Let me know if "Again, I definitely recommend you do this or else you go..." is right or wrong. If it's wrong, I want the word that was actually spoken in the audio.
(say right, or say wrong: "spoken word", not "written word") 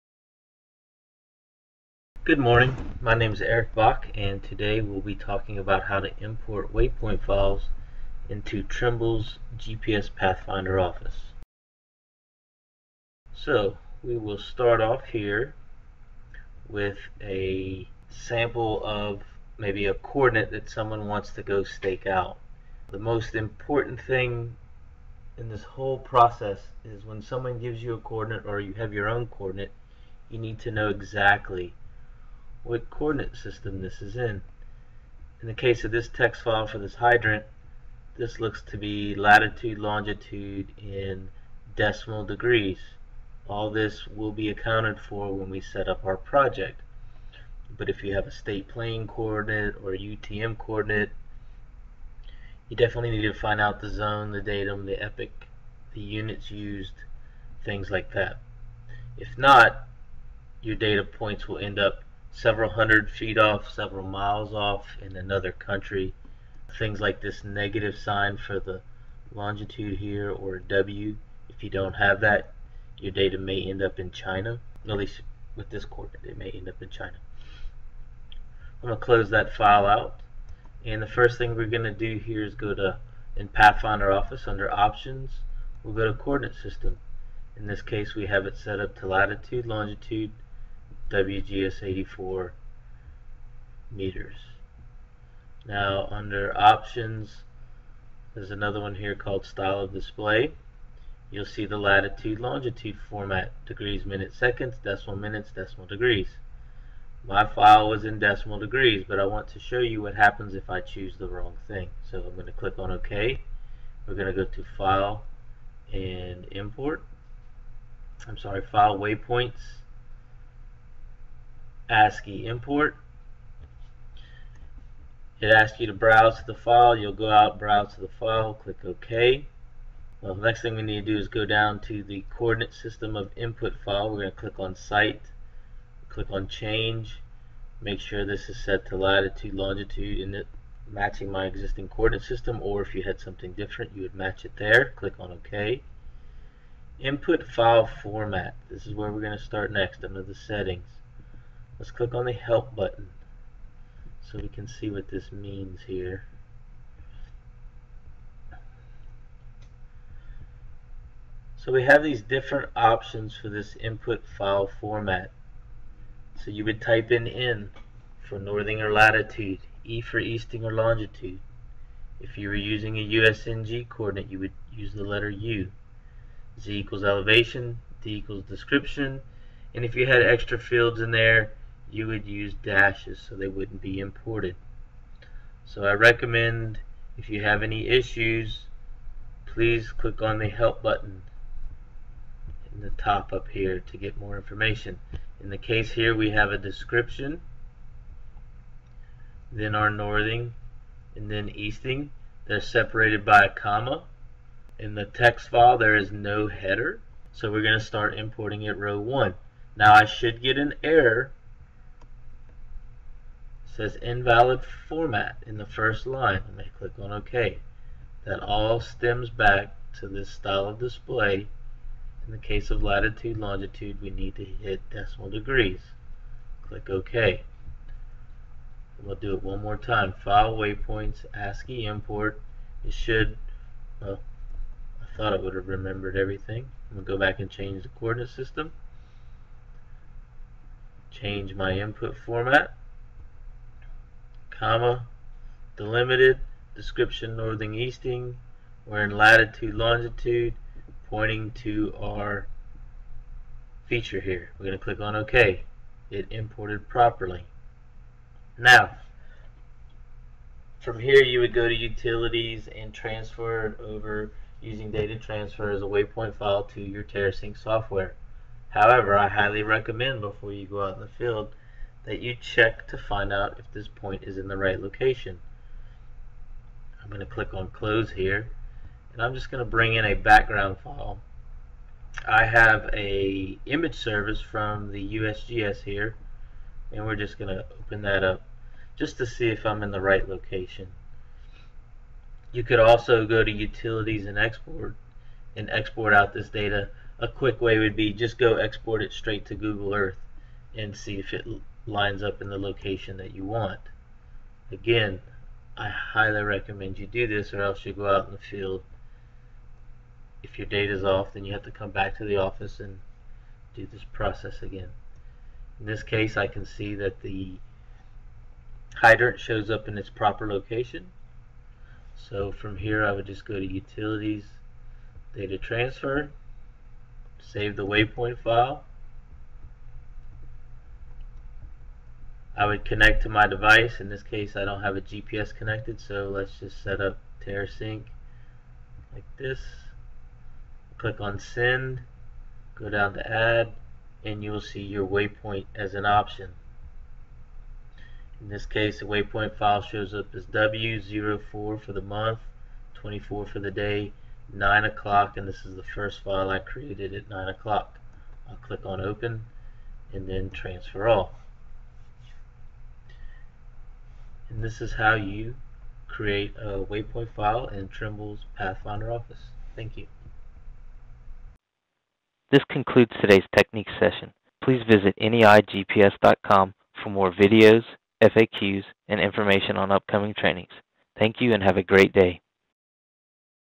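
wrong: "highly", not "definitely".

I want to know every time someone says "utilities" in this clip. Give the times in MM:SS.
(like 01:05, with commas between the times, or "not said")
04:21, 04:53, 05:23.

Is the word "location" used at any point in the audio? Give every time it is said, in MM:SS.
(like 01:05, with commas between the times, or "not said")
04:34, 04:50, 05:02, 05:20.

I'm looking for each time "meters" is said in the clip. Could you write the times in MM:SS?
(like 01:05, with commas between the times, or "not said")
01:33.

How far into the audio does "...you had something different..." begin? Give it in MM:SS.
02:22.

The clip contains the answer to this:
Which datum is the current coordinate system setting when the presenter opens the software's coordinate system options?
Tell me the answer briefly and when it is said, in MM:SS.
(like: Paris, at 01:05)
WGS 84, at 01:31.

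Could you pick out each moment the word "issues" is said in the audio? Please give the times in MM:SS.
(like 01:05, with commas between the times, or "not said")
03:07.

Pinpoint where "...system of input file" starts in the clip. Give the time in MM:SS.
02:12.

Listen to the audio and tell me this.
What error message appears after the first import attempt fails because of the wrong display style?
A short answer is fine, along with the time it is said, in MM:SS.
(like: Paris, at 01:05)
Invalid format, at 03:34.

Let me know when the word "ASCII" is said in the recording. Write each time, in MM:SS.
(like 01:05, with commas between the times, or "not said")
02:01, 03:51.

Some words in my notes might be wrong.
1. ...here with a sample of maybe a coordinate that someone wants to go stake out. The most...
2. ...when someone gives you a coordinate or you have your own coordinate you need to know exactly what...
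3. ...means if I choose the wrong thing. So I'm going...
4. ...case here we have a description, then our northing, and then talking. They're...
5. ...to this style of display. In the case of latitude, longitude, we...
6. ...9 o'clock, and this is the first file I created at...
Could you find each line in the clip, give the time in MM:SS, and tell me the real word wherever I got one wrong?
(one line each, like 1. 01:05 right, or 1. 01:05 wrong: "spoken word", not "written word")
1. 00:15 right
2. 00:27 right
3. 01:50 wrong: "happens", not "means"
4. 03:15 wrong: "easting", not "talking"
5. 03:40 right
6. 05:54 right.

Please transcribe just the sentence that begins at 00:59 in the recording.
If not, your data points will end up several hundred feet off, several miles off in another country.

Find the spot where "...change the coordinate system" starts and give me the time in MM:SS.
03:57.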